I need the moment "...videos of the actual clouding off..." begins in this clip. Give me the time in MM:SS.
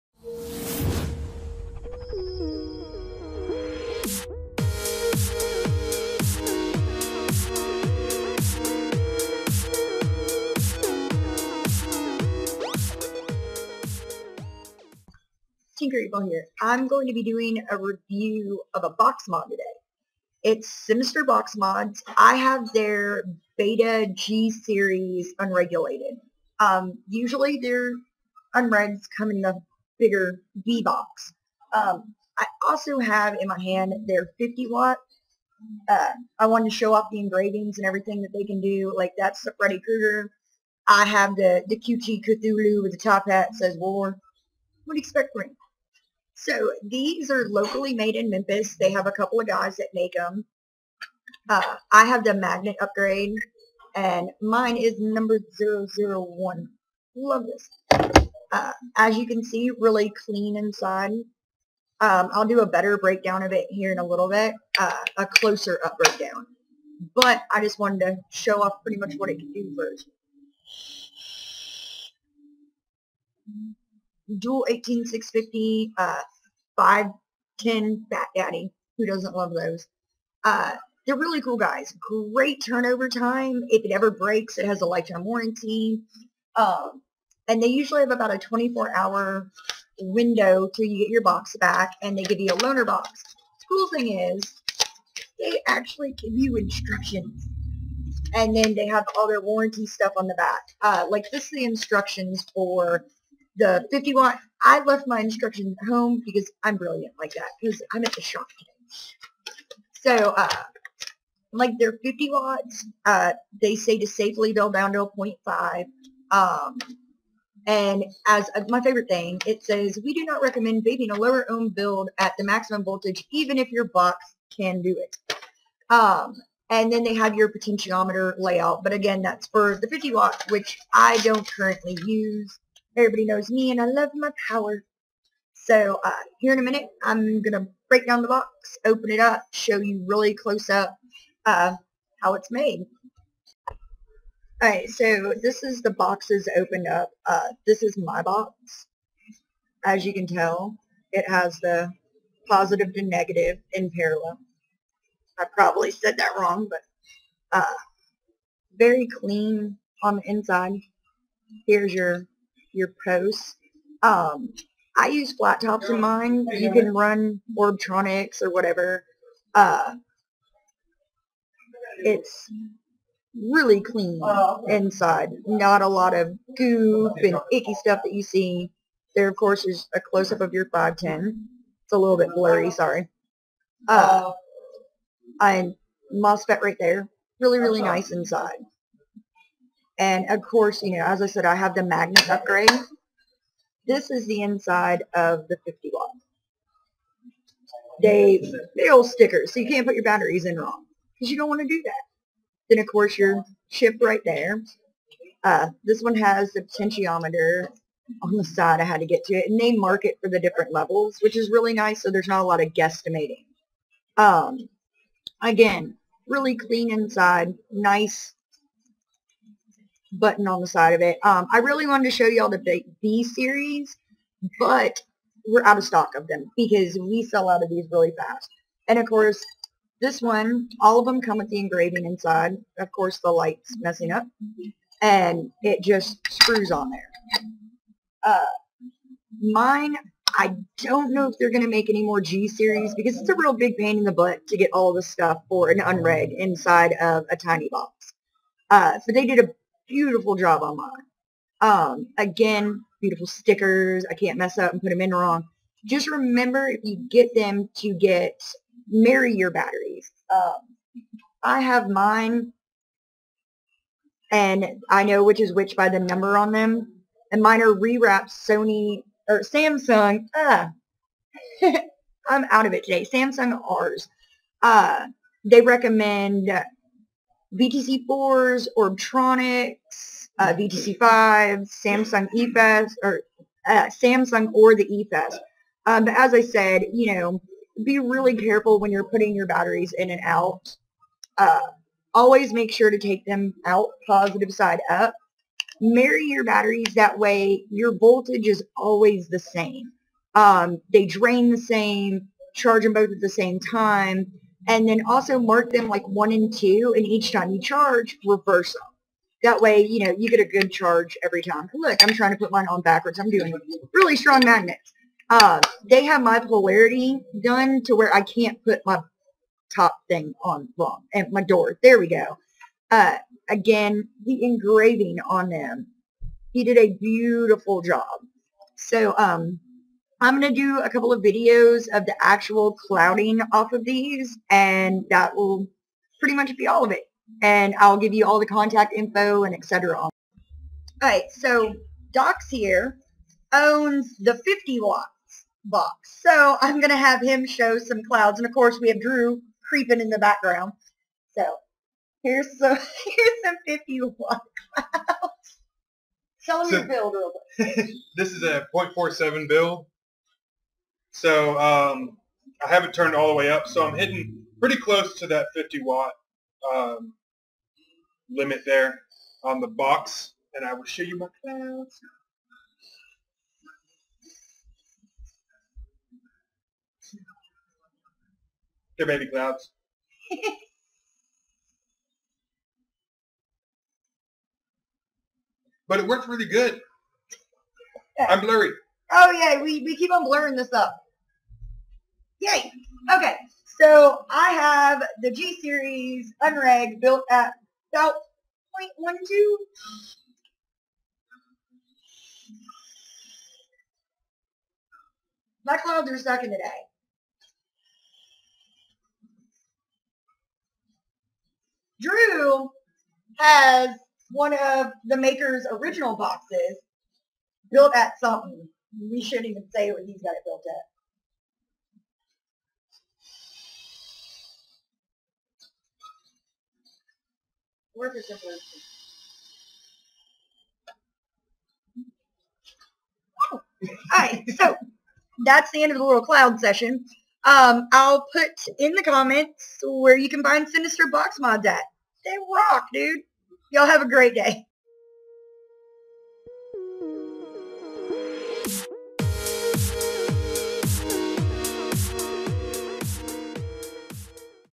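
05:31.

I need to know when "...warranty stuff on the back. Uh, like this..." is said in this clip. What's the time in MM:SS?
01:39.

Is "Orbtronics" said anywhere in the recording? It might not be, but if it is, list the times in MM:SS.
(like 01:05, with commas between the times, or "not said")
02:47, 04:38.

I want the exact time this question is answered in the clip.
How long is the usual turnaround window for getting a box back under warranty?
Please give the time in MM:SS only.
01:28.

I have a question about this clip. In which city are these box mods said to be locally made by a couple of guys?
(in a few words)
Memphis.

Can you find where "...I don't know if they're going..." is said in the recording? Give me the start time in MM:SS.
04:00.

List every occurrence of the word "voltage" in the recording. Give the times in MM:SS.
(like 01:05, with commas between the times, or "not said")
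02:02, 04:57.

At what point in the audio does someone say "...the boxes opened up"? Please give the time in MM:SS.
02:25.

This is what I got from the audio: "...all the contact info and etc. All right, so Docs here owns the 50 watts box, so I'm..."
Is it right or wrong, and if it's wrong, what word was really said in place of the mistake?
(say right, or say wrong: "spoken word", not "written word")
right.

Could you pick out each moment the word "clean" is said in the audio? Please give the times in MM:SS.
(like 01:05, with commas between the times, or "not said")
01:00, 02:39, 02:53, 03:36.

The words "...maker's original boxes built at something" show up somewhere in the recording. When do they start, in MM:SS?
06:55.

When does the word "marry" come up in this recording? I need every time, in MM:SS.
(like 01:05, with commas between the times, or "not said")
04:18, 04:55.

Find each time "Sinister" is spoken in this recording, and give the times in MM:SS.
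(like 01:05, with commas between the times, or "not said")
00:20, 07:20.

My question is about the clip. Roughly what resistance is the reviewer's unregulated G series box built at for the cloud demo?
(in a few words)
0.12.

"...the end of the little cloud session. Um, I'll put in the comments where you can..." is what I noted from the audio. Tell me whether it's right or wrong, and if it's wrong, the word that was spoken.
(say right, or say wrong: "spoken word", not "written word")
right.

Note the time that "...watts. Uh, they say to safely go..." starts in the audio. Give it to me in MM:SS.
01:52.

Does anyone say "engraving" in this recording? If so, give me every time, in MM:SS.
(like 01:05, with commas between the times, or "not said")
00:37, 03:51, 05:24.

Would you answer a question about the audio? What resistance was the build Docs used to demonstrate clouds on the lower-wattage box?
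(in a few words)
0.47.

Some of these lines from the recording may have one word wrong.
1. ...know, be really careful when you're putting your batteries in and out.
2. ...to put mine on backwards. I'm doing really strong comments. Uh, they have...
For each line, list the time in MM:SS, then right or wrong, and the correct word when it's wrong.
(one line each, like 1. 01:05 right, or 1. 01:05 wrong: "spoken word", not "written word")
1. 04:47 right
2. 05:12 wrong: "magnets", not "comments".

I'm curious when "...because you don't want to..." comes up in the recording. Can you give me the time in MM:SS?
03:21.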